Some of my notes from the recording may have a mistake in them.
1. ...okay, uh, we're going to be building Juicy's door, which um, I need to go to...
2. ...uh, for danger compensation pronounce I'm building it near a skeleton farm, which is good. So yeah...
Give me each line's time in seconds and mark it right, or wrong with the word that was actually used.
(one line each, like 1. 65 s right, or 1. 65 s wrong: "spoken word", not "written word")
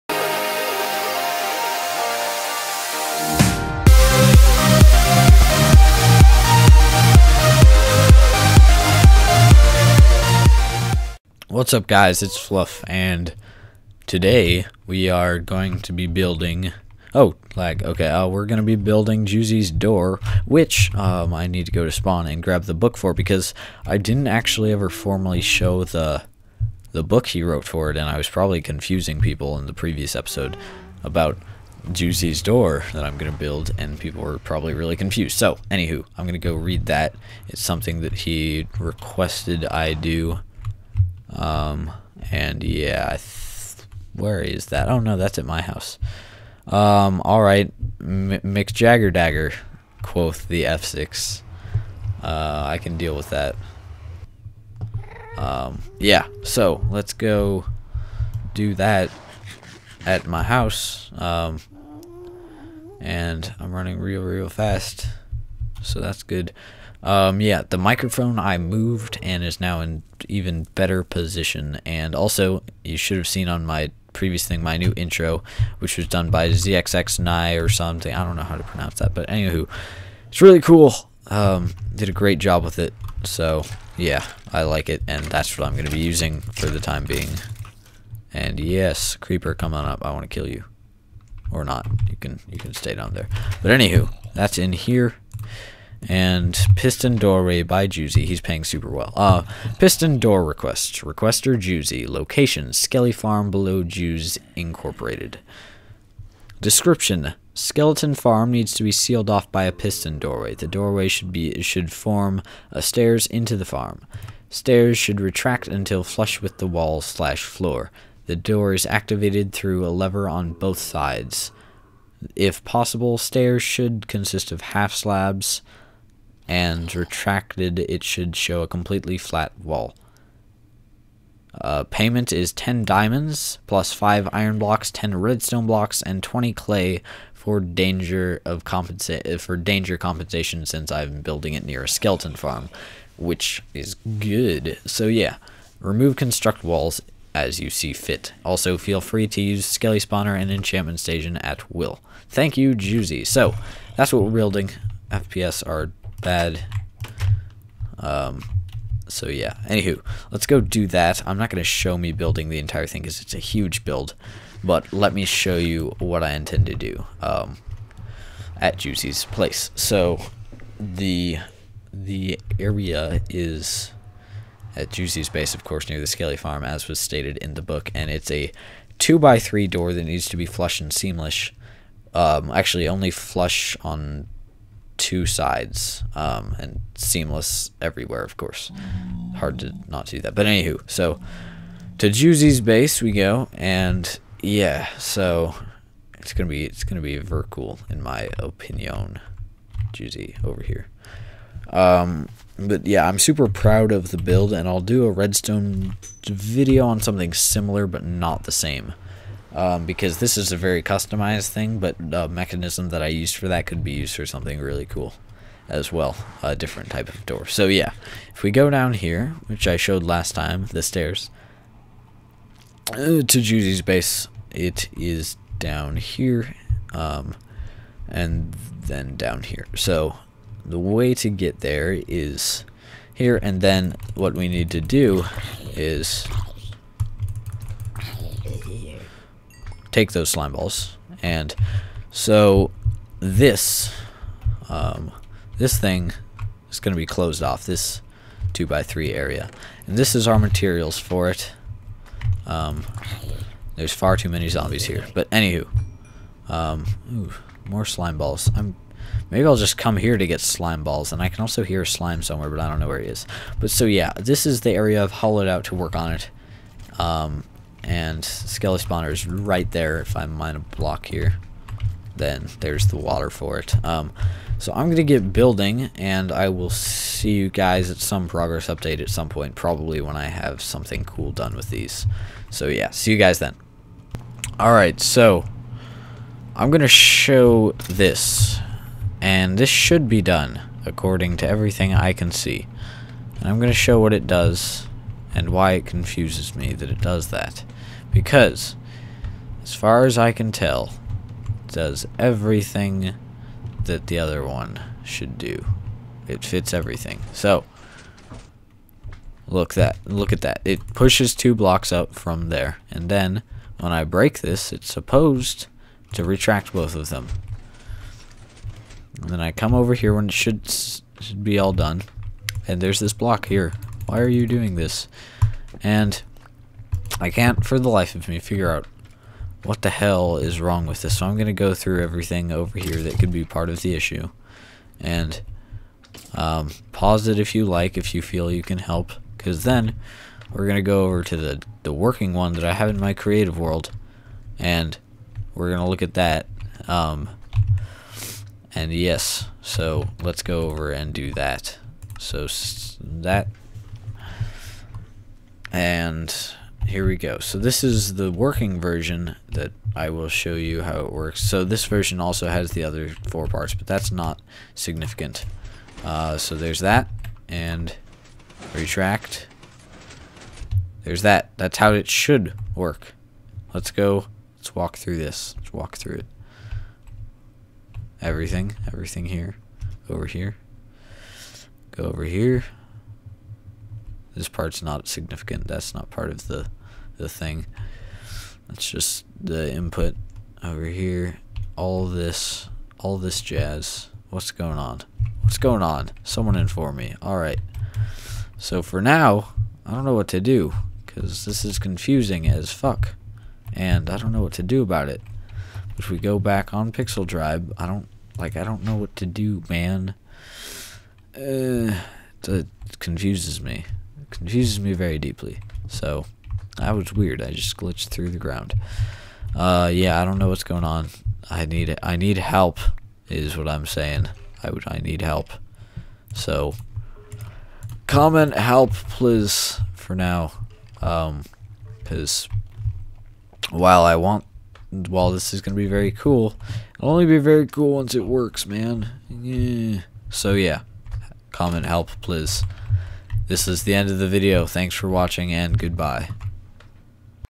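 1. 17 s right
2. 139 s wrong: "since", not "pronounce".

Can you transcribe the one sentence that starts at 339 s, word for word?
Because then we're going to go over to the, the working one that I have in my creative world.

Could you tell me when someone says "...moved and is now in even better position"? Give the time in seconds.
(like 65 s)
68 s.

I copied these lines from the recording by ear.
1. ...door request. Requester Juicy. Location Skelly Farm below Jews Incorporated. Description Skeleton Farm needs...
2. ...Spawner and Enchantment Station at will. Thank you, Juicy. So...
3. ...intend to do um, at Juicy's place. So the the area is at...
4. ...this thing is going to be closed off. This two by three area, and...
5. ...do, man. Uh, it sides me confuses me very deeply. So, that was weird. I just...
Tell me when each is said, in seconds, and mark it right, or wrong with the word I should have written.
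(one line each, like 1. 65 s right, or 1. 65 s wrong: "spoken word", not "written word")
1. 100 s right
2. 150 s right
3. 166 s right
4. 245 s right
5. 409 s wrong: "confuses", not "sides".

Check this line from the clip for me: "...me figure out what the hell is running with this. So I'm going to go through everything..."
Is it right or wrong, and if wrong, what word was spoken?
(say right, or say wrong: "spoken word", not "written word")
wrong: "wrong", not "running".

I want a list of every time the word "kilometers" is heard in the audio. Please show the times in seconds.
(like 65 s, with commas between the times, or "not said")
not said.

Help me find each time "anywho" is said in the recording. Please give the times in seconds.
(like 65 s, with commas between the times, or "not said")
35 s, 79 s, 93 s, 159 s, 190 s, 255 s.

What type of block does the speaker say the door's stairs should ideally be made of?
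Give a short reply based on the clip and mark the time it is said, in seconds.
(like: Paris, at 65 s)
half slabs, at 124 s.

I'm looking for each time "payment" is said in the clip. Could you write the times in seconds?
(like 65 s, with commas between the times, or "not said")
131 s.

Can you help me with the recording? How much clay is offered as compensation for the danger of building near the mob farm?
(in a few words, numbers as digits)
20.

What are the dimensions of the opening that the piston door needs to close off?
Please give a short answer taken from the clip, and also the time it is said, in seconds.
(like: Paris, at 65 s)
2 by 3, at 178 s.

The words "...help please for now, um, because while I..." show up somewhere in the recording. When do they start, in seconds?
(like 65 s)
428 s.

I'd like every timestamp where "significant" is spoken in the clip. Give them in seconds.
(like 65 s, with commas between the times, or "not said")
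364 s, 385 s.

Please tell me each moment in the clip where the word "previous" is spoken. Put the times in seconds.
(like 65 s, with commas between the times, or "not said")
29 s, 74 s.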